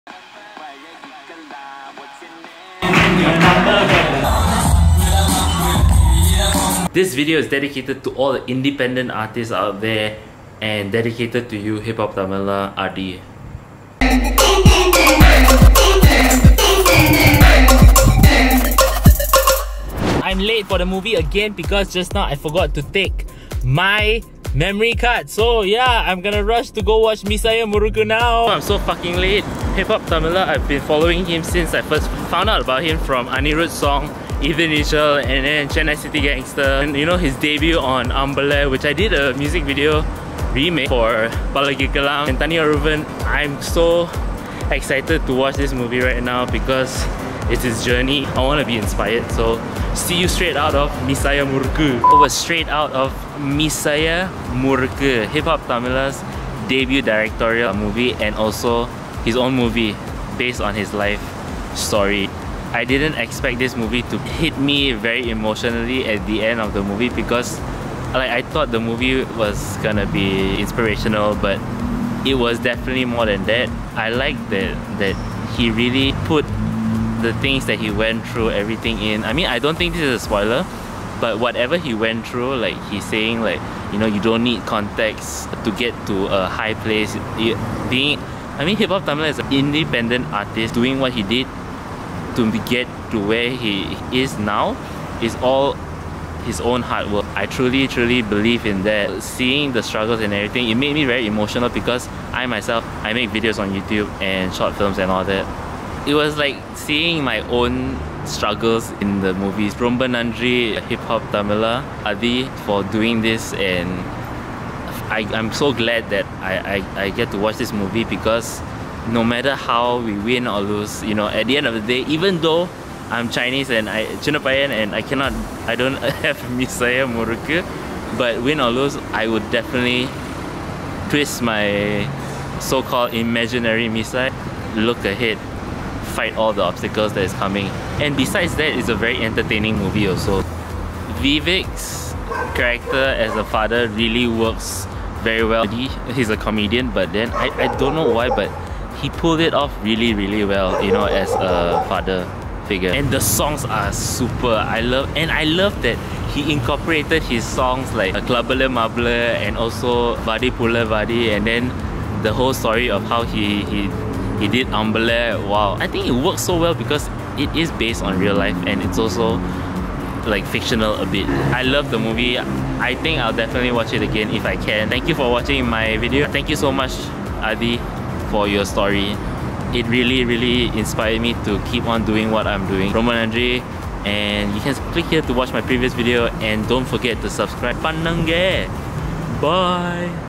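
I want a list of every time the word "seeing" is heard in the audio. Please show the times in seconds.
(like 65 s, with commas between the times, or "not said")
99 s, 106 s.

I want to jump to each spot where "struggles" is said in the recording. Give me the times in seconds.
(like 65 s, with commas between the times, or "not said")
99 s, 108 s.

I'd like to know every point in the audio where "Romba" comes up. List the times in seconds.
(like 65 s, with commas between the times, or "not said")
109 s, 182 s.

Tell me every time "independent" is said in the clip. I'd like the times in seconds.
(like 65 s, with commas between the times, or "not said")
8 s, 89 s.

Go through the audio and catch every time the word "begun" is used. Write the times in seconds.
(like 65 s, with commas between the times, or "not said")
not said.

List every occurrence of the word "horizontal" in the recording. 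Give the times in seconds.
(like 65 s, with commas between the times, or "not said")
not said.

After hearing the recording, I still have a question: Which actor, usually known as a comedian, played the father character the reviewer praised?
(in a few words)
Vivek.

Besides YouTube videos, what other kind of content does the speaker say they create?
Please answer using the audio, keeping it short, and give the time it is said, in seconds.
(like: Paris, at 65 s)
short films, at 104 s.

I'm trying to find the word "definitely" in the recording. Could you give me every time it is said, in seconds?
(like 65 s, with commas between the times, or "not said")
72 s, 129 s, 173 s.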